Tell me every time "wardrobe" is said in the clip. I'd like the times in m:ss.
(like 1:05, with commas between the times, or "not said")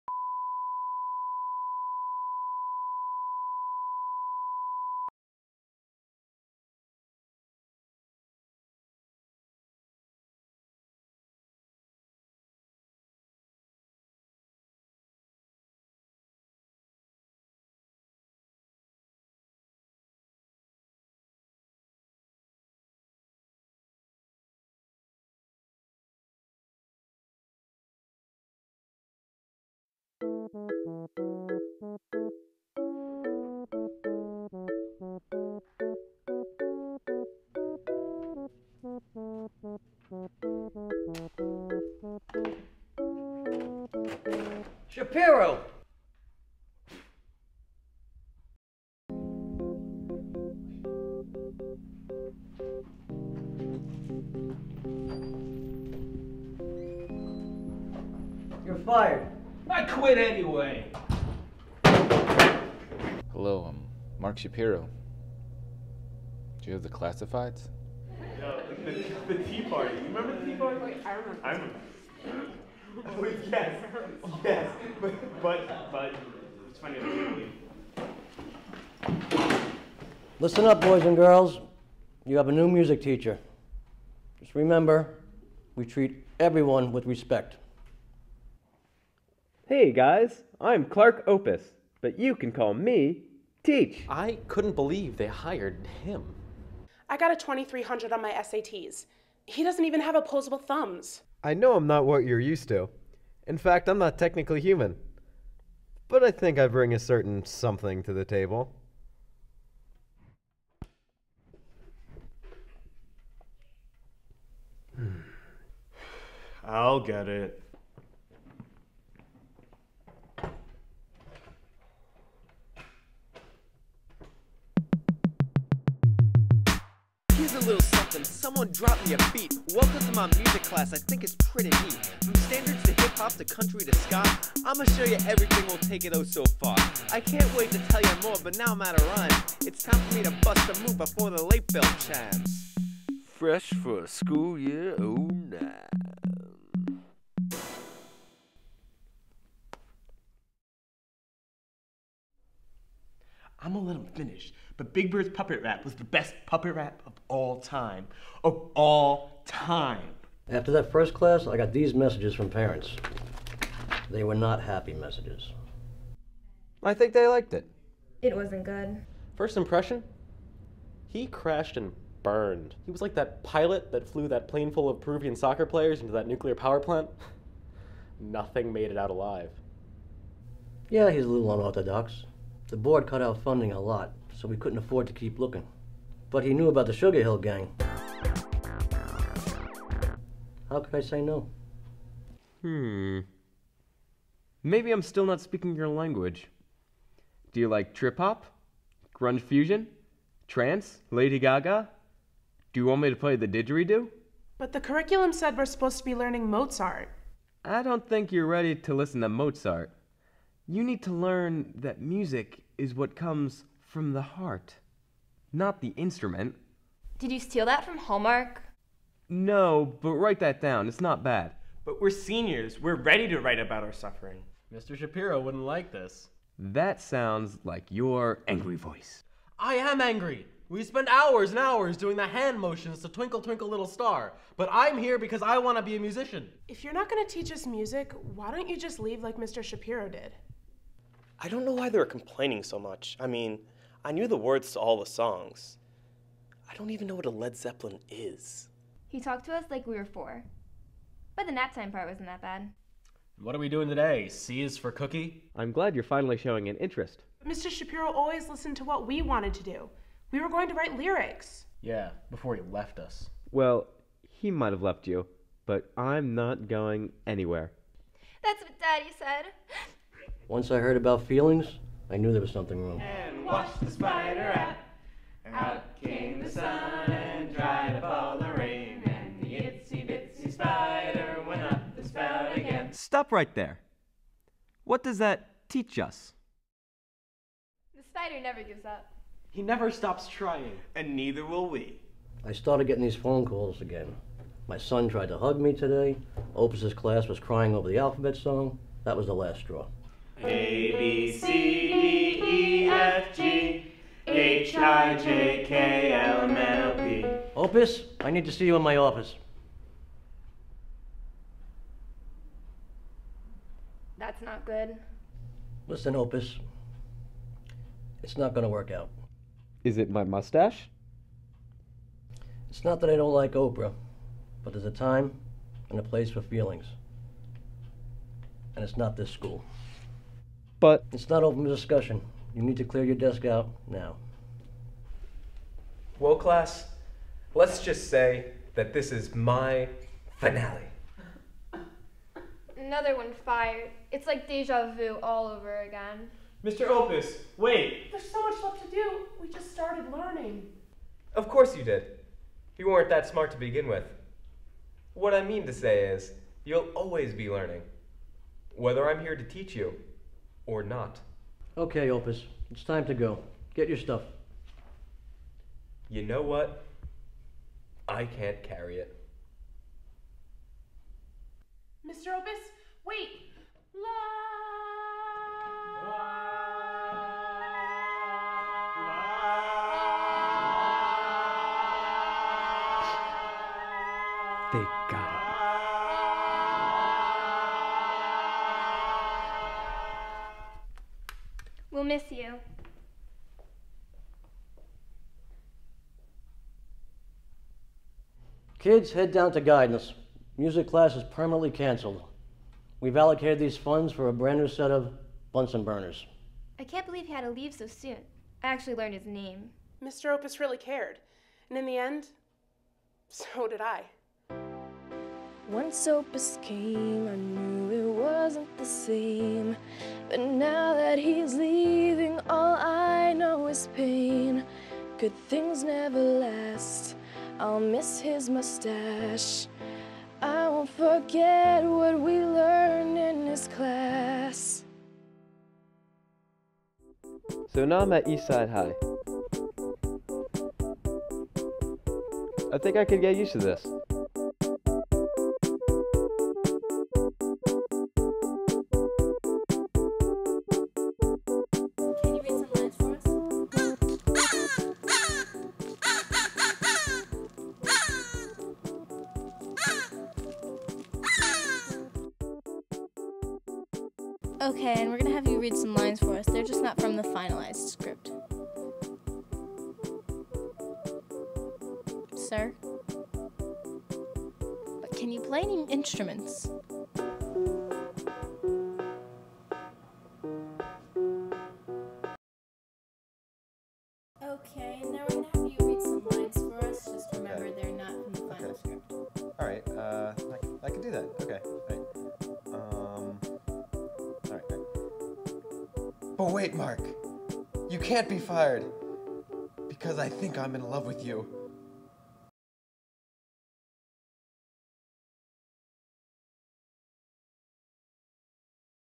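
not said.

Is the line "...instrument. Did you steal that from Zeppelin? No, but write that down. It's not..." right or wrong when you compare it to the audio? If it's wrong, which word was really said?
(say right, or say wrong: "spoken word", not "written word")
wrong: "Hallmark", not "Zeppelin".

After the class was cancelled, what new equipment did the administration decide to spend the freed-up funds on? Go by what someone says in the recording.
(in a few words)
Bunsen burners.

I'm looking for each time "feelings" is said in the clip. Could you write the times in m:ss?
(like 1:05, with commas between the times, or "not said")
4:31, 5:26.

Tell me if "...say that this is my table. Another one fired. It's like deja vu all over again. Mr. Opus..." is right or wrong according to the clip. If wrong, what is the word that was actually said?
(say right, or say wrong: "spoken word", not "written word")
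wrong: "finale", not "table".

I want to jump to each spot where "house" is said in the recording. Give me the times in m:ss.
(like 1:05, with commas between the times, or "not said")
not said.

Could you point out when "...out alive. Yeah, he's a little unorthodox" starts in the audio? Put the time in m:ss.
2:58.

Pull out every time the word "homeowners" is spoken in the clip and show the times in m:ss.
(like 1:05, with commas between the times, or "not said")
not said.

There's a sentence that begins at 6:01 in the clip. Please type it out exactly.
Okay, Opus, it's time to go.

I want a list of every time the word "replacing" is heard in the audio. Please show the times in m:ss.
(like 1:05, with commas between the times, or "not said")
not said.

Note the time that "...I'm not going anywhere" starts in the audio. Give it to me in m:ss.
4:25.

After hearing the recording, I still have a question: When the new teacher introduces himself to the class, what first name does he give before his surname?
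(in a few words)
Clark.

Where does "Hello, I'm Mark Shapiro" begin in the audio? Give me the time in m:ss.
1:03.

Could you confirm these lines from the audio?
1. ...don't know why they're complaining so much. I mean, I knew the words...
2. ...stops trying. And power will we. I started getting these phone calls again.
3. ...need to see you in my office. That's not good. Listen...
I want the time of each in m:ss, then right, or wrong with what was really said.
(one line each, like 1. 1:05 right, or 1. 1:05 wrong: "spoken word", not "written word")
1. 4:01 right
2. 4:49 wrong: "neither", not "power"
3. 5:08 right.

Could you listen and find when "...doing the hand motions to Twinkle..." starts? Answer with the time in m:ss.
3:51.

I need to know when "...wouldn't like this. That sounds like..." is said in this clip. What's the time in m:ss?
3:45.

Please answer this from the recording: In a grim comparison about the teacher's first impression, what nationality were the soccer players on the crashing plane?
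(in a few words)
Peruvian.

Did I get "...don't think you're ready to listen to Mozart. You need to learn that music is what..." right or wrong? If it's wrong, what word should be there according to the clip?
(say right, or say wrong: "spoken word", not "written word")
right.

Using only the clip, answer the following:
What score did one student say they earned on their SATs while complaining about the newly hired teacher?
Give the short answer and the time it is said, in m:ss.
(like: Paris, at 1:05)
2300, at 1:37.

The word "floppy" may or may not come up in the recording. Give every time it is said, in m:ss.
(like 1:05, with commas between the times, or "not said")
not said.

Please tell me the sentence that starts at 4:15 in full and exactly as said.
I'm glad you're finally showing an interest.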